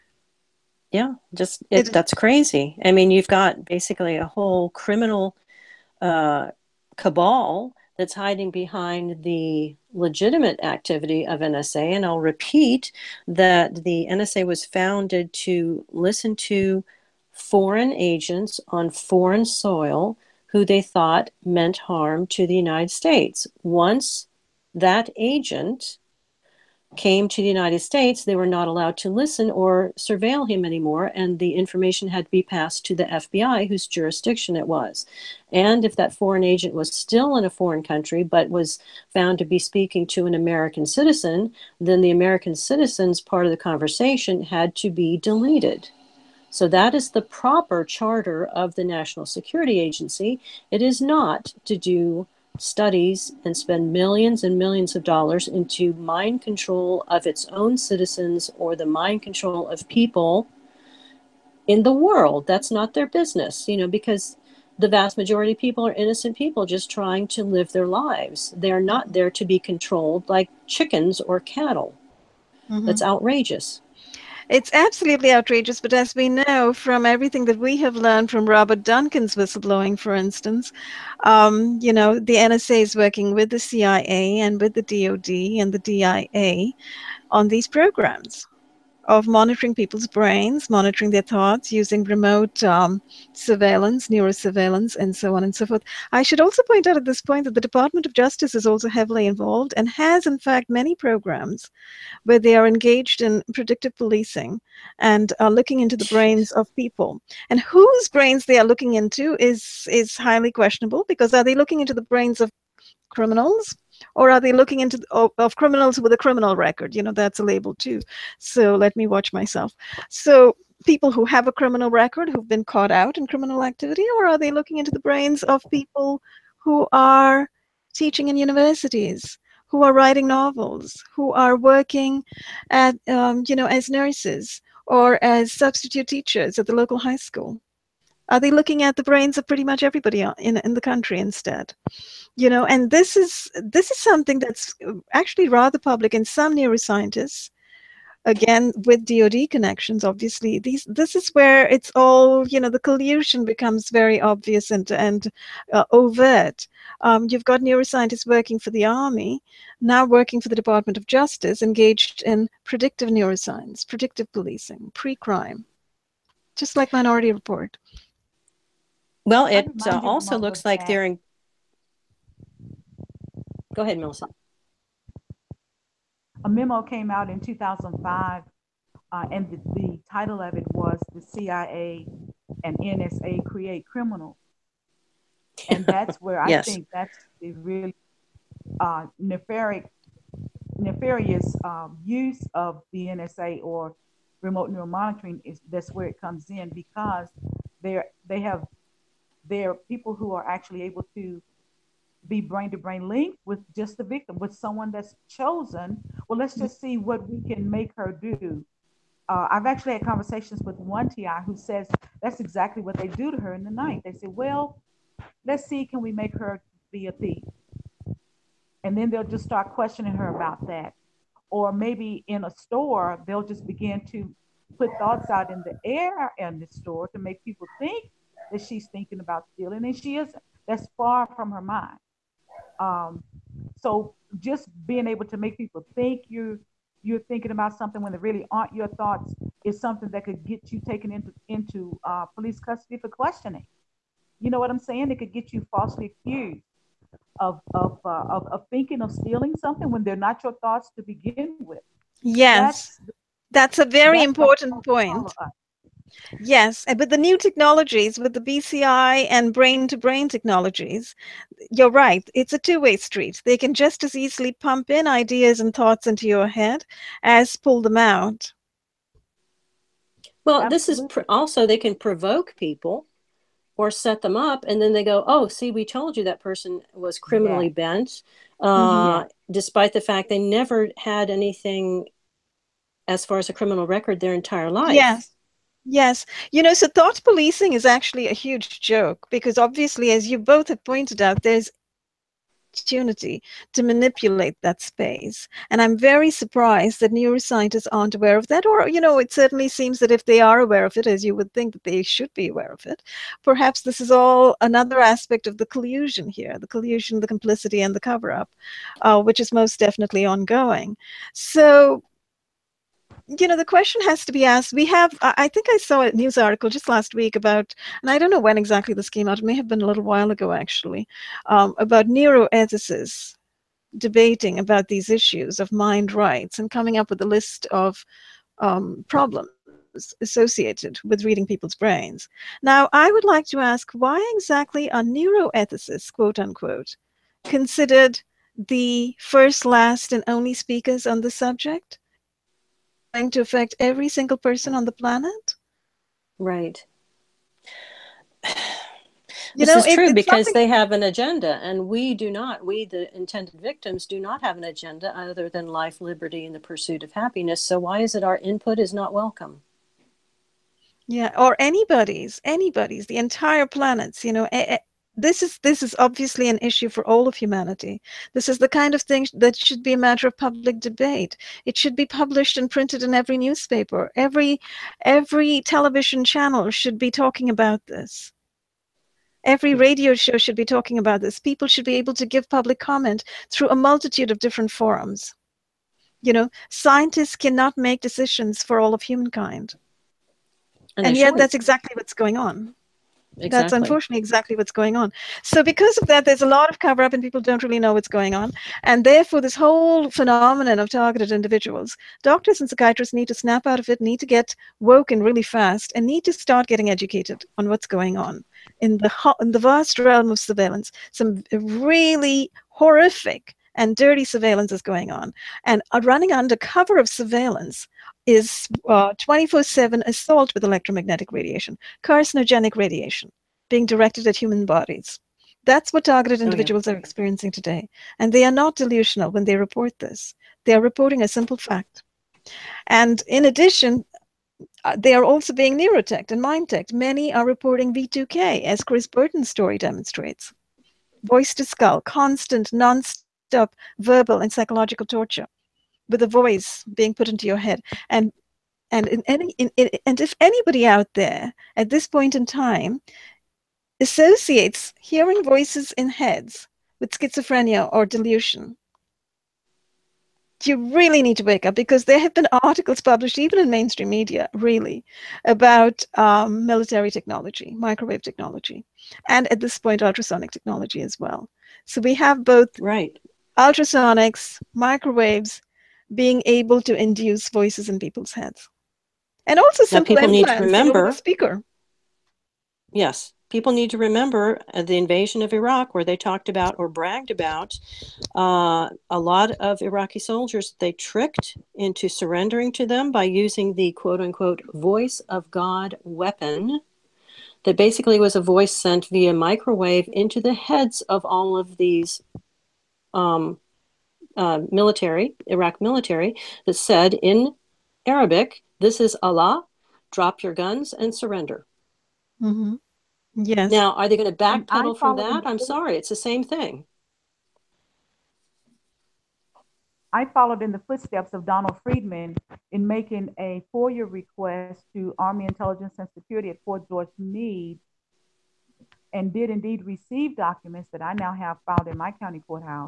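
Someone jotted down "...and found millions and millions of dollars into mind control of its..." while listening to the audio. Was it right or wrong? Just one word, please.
wrong.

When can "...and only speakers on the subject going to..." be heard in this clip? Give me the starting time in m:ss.
5:40.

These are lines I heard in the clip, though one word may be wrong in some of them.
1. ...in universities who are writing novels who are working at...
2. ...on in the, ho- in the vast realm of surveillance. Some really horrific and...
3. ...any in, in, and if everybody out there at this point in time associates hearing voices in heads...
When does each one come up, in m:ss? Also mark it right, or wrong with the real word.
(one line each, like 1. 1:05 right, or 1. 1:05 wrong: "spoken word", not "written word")
1. 2:08 right
2. 6:48 right
3. 7:29 wrong: "anybody", not "everybody".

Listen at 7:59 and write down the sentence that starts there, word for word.
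And also some people need to remember speaker.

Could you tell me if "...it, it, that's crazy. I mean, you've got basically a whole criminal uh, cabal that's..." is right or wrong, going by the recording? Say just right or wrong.
right.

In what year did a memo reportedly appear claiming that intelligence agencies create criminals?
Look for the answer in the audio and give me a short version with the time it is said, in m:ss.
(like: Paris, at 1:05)
2005, at 2:57.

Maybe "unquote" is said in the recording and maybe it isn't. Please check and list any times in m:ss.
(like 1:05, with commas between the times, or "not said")
5:36, 8:14.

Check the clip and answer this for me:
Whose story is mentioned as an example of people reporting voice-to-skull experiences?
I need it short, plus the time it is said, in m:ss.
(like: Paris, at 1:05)
Chris Burton, at 7:18.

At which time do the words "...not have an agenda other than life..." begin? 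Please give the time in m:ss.
5:54.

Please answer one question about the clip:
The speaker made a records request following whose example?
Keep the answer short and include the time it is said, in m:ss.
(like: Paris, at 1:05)
Donald Friedman, at 8:41.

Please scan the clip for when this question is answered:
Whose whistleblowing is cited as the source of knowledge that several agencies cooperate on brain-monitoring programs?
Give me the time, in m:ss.
1:18.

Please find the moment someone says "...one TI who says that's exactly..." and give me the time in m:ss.
3:30.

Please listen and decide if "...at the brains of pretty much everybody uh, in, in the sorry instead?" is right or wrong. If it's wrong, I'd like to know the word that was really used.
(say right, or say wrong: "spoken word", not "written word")
wrong: "country", not "sorry".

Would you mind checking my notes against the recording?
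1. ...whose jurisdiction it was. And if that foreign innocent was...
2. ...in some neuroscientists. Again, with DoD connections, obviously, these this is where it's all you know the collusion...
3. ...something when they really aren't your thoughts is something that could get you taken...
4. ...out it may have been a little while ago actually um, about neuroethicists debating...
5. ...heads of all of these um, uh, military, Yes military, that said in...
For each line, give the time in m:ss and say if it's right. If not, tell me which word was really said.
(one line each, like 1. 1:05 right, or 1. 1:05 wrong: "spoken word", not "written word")
1. 0:33 wrong: "agent", not "innocent"
2. 2:26 right
3. 3:57 right
4. 5:19 right
5. 8:20 wrong: "Iraq", not "Yes".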